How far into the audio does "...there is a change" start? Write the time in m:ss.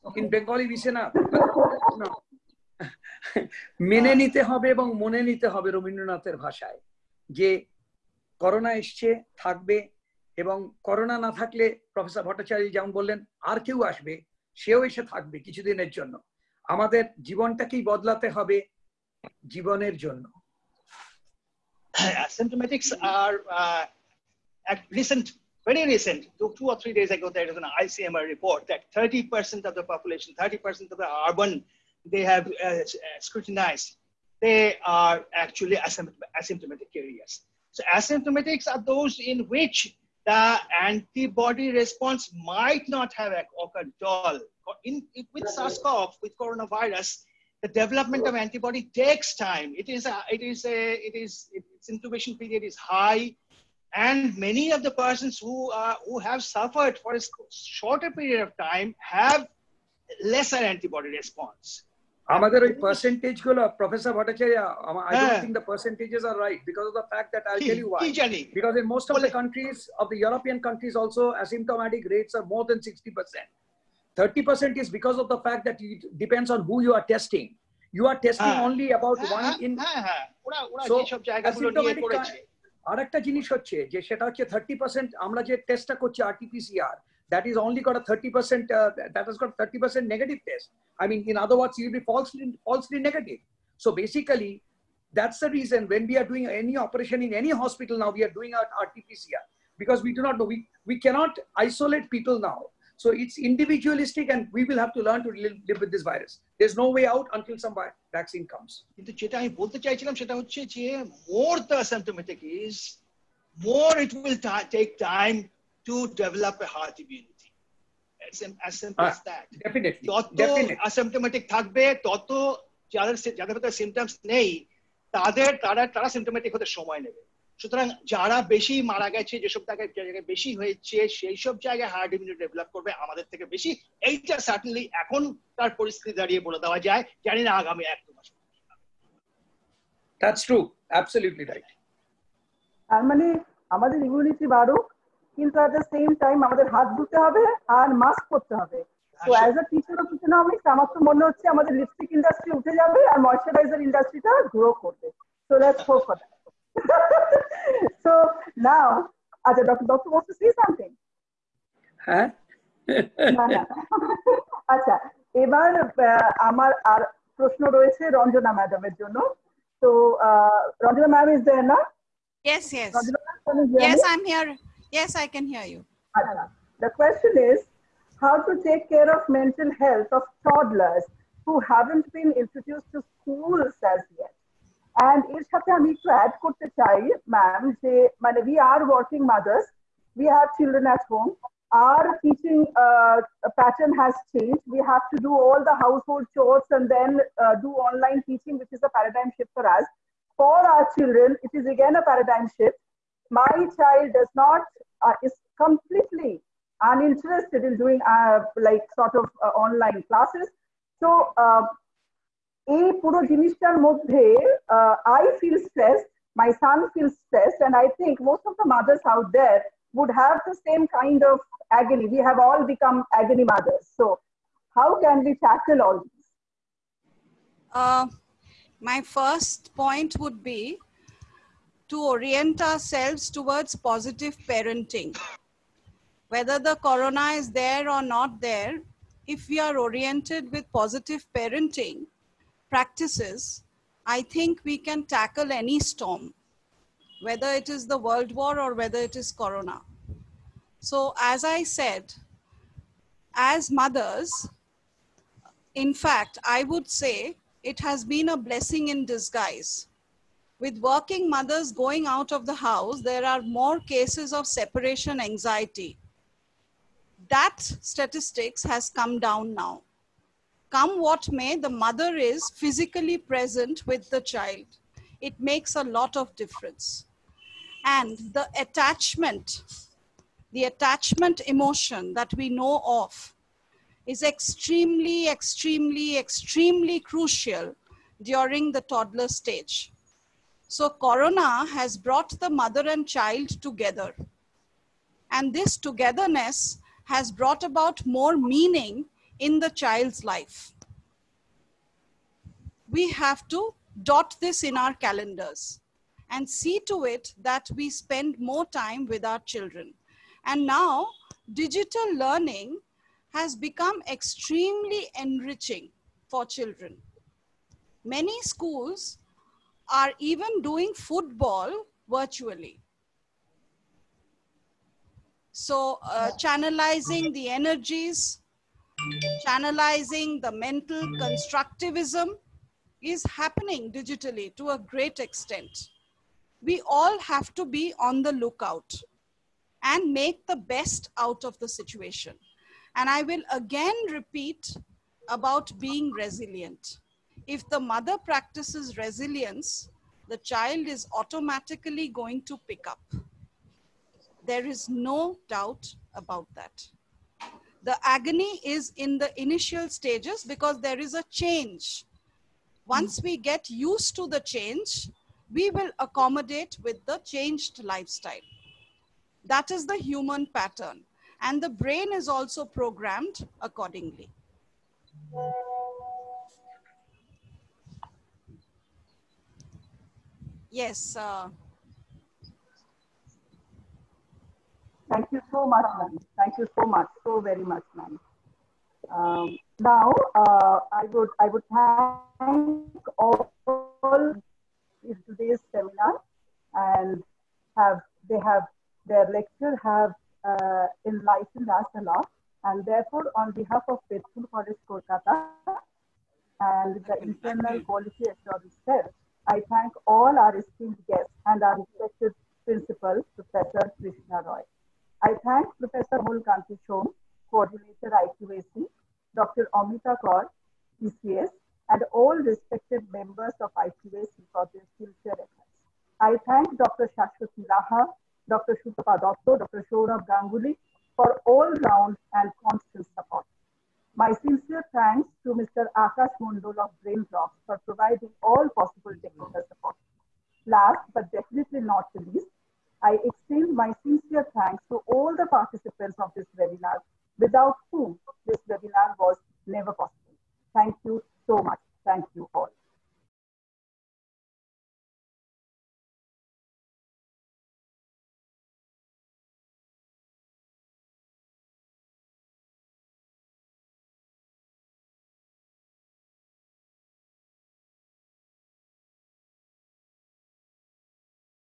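6:00.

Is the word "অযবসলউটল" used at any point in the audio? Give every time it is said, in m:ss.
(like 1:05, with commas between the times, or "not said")
2:20.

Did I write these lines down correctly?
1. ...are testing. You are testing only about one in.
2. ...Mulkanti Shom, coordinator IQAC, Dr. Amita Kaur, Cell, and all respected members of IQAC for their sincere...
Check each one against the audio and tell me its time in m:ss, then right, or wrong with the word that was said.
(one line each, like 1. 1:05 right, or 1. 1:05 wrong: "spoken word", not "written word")
1. 1:16 right
2. 6:56 wrong: "ECS", not "Cell".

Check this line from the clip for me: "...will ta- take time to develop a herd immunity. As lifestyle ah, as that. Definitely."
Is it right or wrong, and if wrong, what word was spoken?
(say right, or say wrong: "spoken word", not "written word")
wrong: "simple", not "lifestyle".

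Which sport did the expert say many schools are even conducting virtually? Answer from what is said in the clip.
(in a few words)
Football.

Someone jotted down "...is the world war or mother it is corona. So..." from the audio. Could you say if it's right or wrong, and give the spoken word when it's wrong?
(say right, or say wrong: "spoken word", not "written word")
wrong: "whether", not "mother".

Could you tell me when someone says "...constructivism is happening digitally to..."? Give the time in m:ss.
5:31.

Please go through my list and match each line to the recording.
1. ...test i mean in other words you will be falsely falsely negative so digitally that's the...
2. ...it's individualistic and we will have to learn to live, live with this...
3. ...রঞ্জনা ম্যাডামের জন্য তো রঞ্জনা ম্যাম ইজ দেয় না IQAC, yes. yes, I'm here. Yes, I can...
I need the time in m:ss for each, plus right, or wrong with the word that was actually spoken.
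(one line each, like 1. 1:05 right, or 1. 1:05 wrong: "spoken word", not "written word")
1. 1:30 wrong: "basically", not "digitally"
2. 1:43 right
3. 2:48 wrong: "Yes", not "IQAC".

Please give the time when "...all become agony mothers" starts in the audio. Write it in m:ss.
3:42.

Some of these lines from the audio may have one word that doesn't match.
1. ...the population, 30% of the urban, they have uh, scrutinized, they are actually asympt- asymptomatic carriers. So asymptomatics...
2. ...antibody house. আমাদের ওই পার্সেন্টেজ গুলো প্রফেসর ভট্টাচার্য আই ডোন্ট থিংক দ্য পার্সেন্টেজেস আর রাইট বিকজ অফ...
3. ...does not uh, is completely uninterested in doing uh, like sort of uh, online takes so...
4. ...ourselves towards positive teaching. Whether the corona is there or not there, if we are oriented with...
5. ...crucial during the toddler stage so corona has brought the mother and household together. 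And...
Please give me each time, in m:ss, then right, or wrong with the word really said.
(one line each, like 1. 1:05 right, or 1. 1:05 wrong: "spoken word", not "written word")
1. 0:29 right
2. 1:00 wrong: "response", not "house"
3. 3:24 wrong: "classes", not "takes"
4. 3:52 wrong: "parenting", not "teaching"
5. 4:47 wrong: "child", not "household".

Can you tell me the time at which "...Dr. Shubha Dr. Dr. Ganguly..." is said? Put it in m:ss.
7:08.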